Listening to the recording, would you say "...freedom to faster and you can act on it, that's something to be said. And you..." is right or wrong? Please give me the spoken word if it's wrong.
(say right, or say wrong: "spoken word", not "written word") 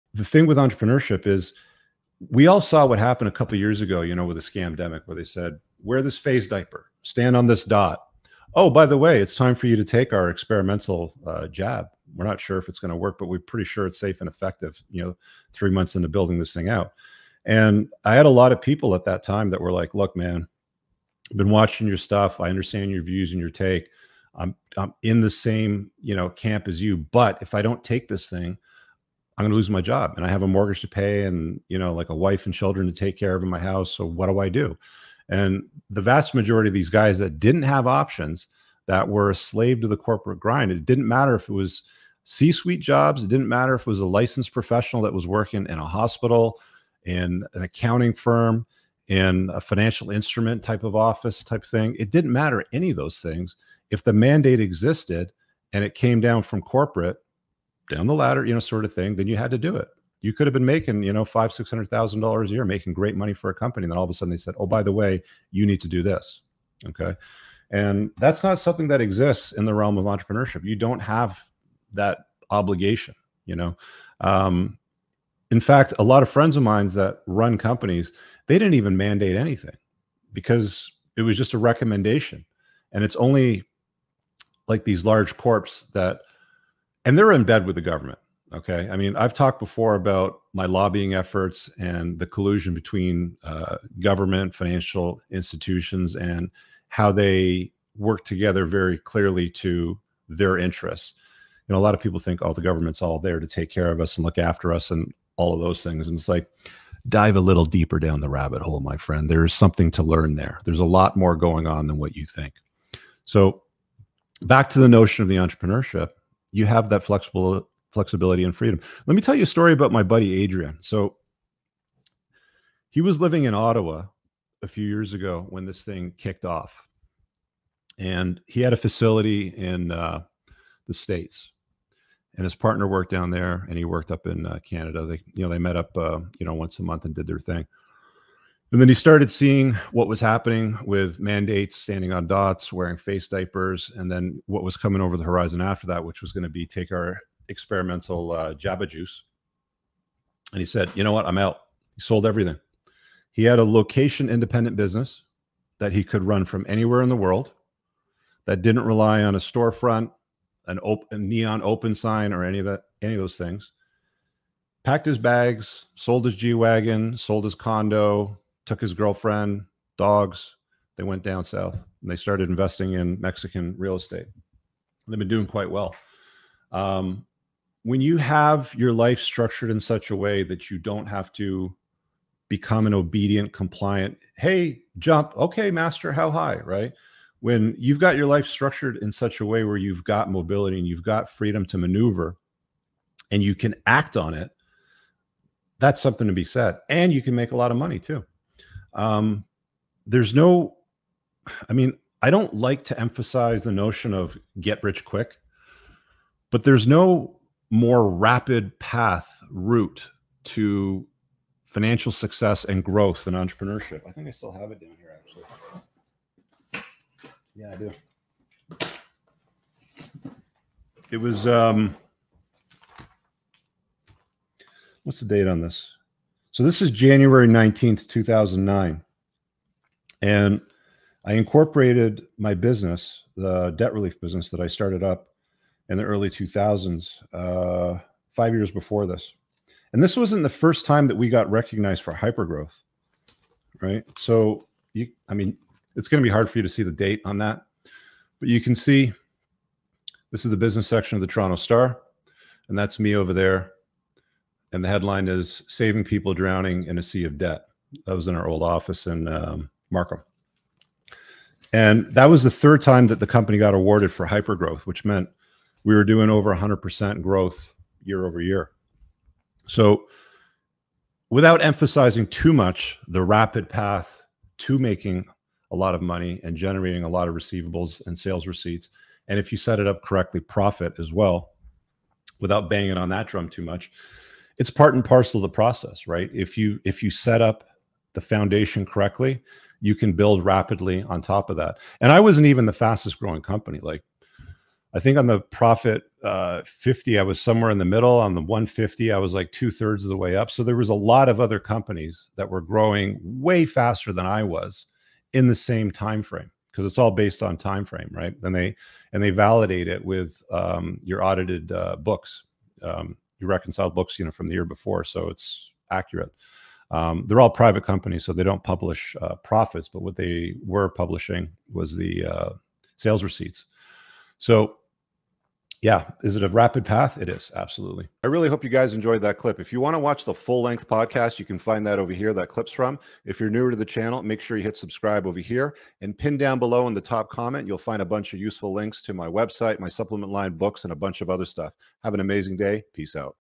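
wrong: "maneuver", not "faster".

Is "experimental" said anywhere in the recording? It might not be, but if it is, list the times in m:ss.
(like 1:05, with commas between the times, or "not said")
0:10, 2:27.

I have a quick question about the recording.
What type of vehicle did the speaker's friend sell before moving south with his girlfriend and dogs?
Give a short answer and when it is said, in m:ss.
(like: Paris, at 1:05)
G Wagon, at 2:46.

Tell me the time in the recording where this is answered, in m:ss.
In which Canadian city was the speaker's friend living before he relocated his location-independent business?
2:03.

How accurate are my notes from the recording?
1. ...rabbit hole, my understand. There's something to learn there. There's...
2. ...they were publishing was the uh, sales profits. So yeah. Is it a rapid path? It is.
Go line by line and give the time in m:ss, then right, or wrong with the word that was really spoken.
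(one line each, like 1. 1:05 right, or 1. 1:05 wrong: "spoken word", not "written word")
1. 1:48 wrong: "friend", not "understand"
2. 5:20 wrong: "receipts", not "profits".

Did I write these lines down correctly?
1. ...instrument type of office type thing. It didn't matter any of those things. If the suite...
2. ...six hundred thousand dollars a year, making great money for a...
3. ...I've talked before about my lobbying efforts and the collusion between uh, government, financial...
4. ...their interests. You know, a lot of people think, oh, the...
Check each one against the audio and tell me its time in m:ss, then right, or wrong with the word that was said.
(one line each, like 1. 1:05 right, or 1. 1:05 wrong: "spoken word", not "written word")
1. 0:50 wrong: "mandate", not "suite"
2. 1:01 right
3. 1:29 right
4. 1:40 right.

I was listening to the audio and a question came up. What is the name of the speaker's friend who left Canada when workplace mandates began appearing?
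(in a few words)
Adrian.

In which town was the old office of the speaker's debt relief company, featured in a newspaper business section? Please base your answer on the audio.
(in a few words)
Markham.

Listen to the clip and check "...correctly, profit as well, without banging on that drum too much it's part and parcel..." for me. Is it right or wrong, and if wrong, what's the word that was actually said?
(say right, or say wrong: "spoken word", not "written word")
right.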